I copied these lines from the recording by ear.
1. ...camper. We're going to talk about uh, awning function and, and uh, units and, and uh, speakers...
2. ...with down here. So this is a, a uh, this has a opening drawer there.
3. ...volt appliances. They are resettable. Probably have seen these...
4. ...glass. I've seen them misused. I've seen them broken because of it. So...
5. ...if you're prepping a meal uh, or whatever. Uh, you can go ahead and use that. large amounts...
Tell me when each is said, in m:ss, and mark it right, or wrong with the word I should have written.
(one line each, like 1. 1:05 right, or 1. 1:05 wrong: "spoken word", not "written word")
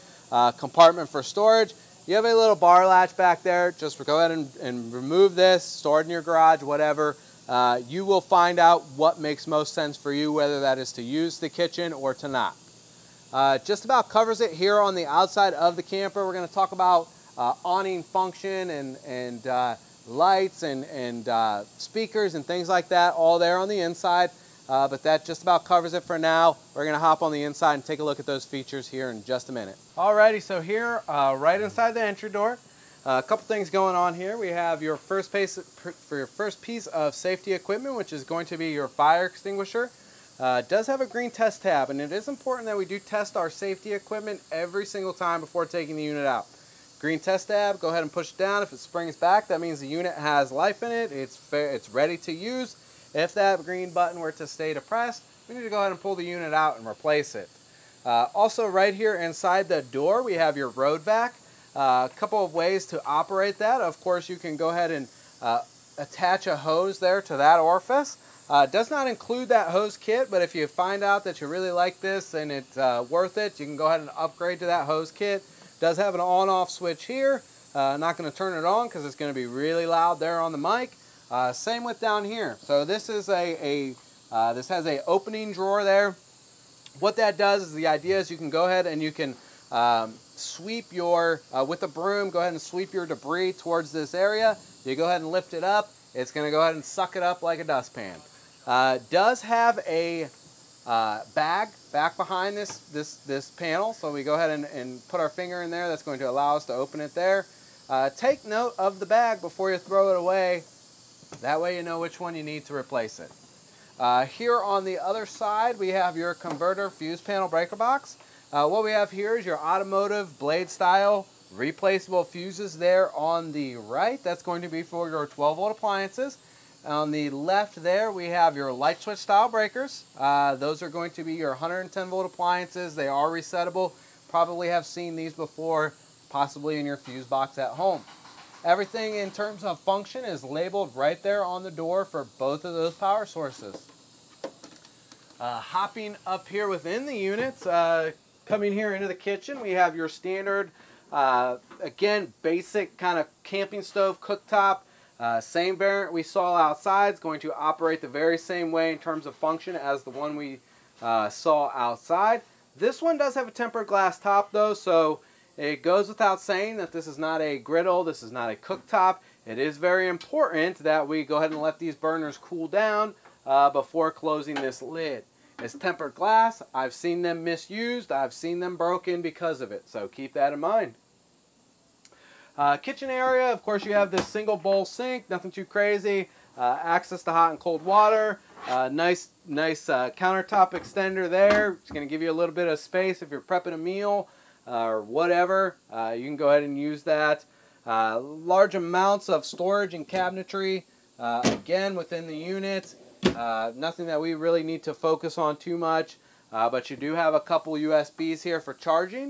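1. 0:15 wrong: "lights", not "units"
2. 1:21 right
3. 2:12 right
4. 2:56 right
5. 3:13 right.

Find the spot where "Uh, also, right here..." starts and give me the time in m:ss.
0:58.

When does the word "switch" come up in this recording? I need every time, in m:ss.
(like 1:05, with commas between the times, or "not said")
1:16, 2:09.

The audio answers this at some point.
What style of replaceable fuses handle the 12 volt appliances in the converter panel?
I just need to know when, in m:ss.
1:59.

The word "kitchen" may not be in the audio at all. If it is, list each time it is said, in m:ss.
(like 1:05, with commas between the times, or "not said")
0:11, 2:29, 3:02.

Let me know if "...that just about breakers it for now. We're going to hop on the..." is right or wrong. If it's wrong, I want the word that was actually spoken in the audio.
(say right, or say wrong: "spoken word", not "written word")
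wrong: "covers", not "breakers".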